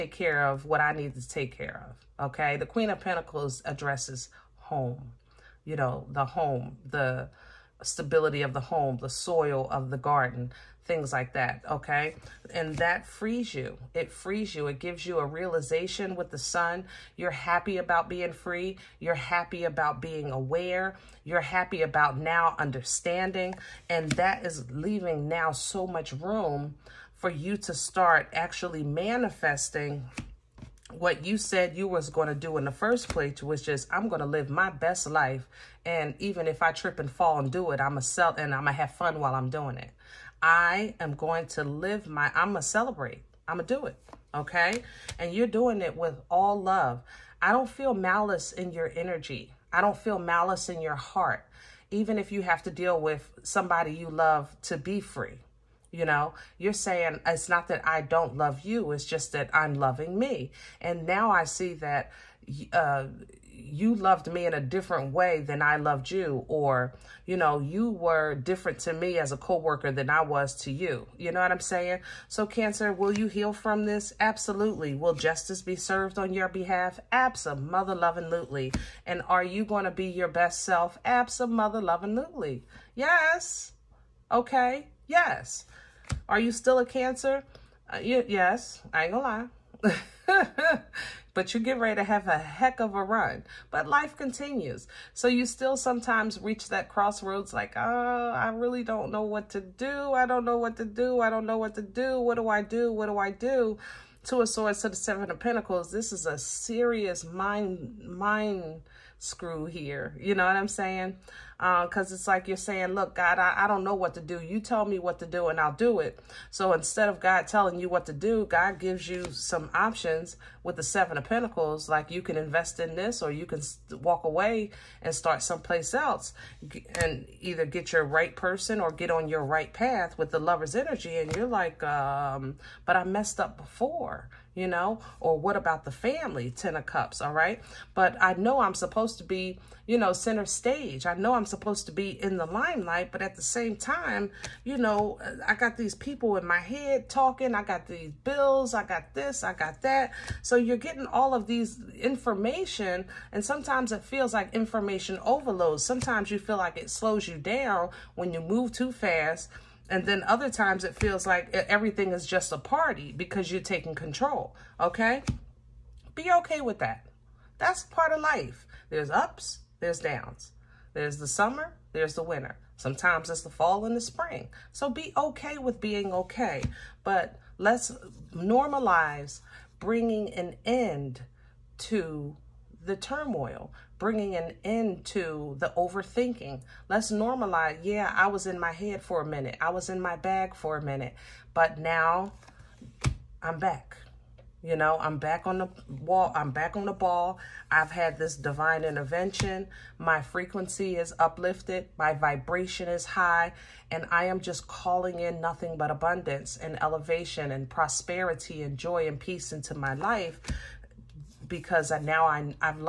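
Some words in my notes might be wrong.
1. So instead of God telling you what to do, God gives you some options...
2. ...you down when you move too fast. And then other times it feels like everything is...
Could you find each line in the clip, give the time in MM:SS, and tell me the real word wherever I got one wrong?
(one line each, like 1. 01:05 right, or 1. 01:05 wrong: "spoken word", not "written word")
1. 01:56 right
2. 02:37 right.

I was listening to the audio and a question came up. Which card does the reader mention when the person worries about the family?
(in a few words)
Ten of Cups.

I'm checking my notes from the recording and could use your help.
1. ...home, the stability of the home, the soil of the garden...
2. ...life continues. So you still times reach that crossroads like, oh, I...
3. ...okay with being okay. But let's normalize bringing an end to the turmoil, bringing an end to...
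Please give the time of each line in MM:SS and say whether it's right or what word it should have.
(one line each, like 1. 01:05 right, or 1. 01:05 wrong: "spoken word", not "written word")
1. 00:06 right
2. 01:33 wrong: "sometimes", not "times"
3. 02:55 right.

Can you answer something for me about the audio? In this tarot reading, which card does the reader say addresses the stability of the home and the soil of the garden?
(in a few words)
Queen of Pentacles.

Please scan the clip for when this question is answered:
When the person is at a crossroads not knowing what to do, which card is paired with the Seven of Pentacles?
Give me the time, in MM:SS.
01:44.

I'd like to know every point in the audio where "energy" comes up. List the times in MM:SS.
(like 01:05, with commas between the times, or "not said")
00:48, 02:10.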